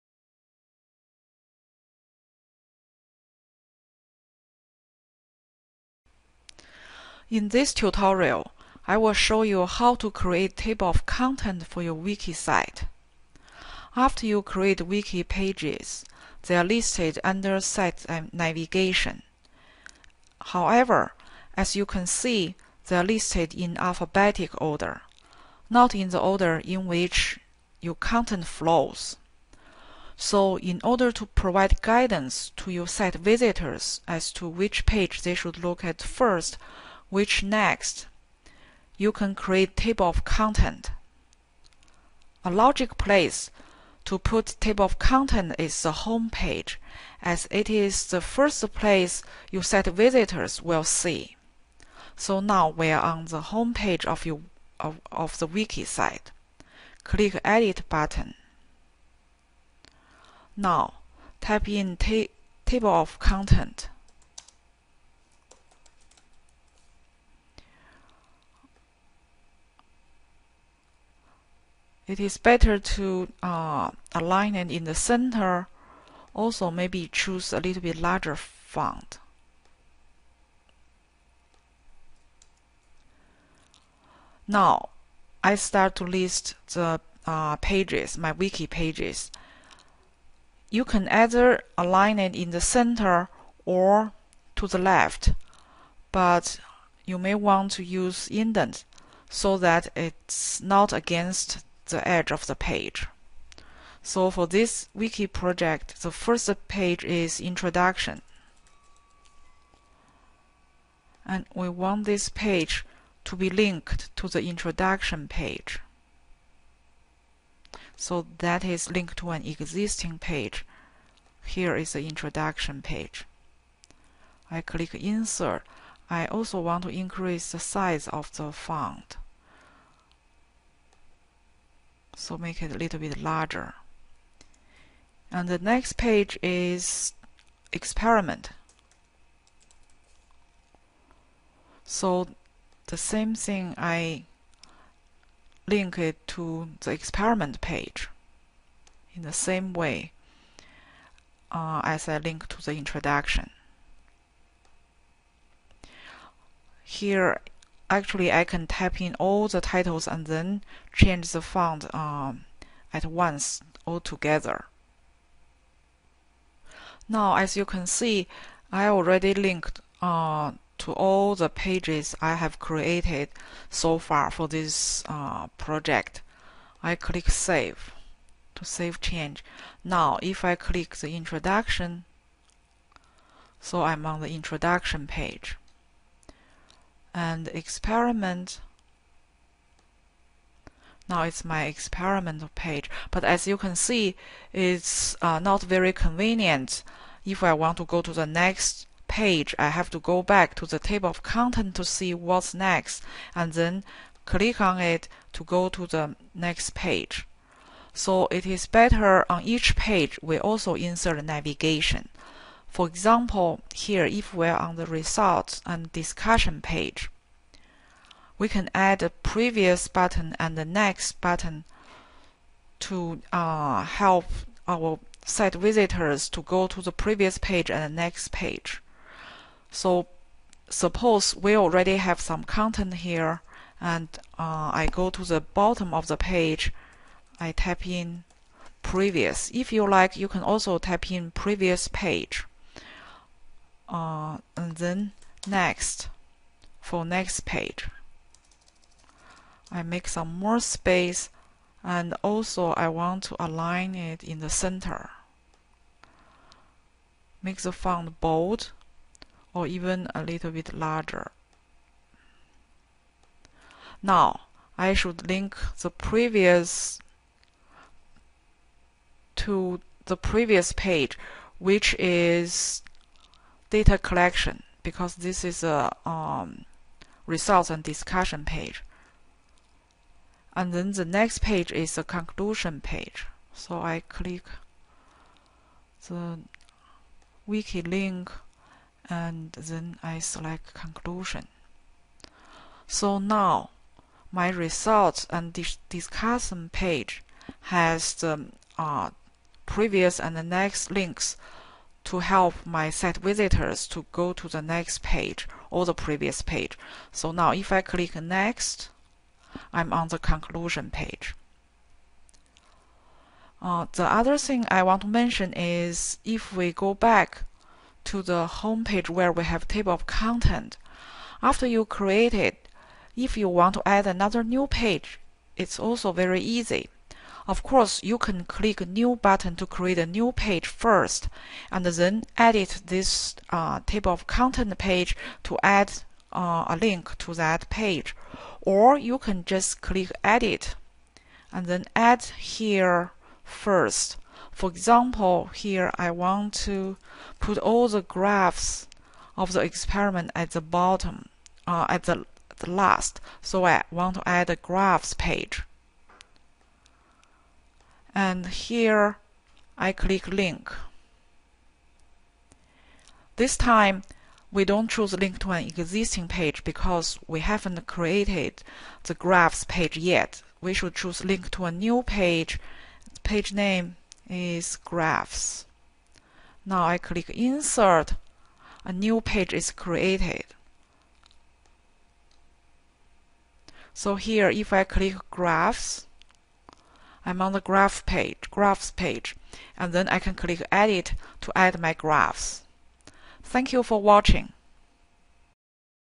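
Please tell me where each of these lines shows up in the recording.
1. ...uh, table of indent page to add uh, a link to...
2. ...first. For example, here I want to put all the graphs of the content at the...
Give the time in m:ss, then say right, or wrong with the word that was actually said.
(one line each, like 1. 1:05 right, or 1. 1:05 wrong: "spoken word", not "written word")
1. 5:33 wrong: "content", not "indent"
2. 5:43 wrong: "experiment", not "content".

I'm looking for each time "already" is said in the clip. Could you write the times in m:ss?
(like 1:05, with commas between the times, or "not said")
2:48, 3:51.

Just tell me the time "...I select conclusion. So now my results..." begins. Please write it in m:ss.
4:50.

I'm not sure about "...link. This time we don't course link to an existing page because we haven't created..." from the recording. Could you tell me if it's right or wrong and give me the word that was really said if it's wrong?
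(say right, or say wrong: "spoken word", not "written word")
wrong: "choose", not "course".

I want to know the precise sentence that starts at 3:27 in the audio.
So it is better on each page we also insert navigation.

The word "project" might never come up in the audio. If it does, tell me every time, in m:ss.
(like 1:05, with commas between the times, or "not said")
1:45, 2:55.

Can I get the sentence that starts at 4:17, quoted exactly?
Make the font bold or even a little bit larger.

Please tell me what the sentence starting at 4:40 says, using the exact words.
And then the next page is a conclusion page.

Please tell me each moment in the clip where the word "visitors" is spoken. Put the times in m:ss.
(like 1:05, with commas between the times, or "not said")
0:33, 0:49, 3:45, 5:03.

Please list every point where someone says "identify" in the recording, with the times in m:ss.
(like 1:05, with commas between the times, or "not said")
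not said.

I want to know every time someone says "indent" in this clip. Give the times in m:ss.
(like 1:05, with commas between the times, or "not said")
1:38.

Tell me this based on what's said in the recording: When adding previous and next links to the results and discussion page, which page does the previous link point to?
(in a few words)
Data collection.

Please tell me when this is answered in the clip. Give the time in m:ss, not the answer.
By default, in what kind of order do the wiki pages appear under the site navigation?
0:23.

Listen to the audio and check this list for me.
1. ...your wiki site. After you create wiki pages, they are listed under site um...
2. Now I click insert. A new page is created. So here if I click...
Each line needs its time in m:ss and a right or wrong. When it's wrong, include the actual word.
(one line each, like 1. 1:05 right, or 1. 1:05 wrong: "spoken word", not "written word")
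1. 0:11 right
2. 6:16 right.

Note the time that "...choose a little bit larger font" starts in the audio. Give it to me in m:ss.
1:17.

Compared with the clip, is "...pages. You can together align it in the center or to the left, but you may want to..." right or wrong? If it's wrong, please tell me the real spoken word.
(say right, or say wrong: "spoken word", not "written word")
wrong: "either", not "together".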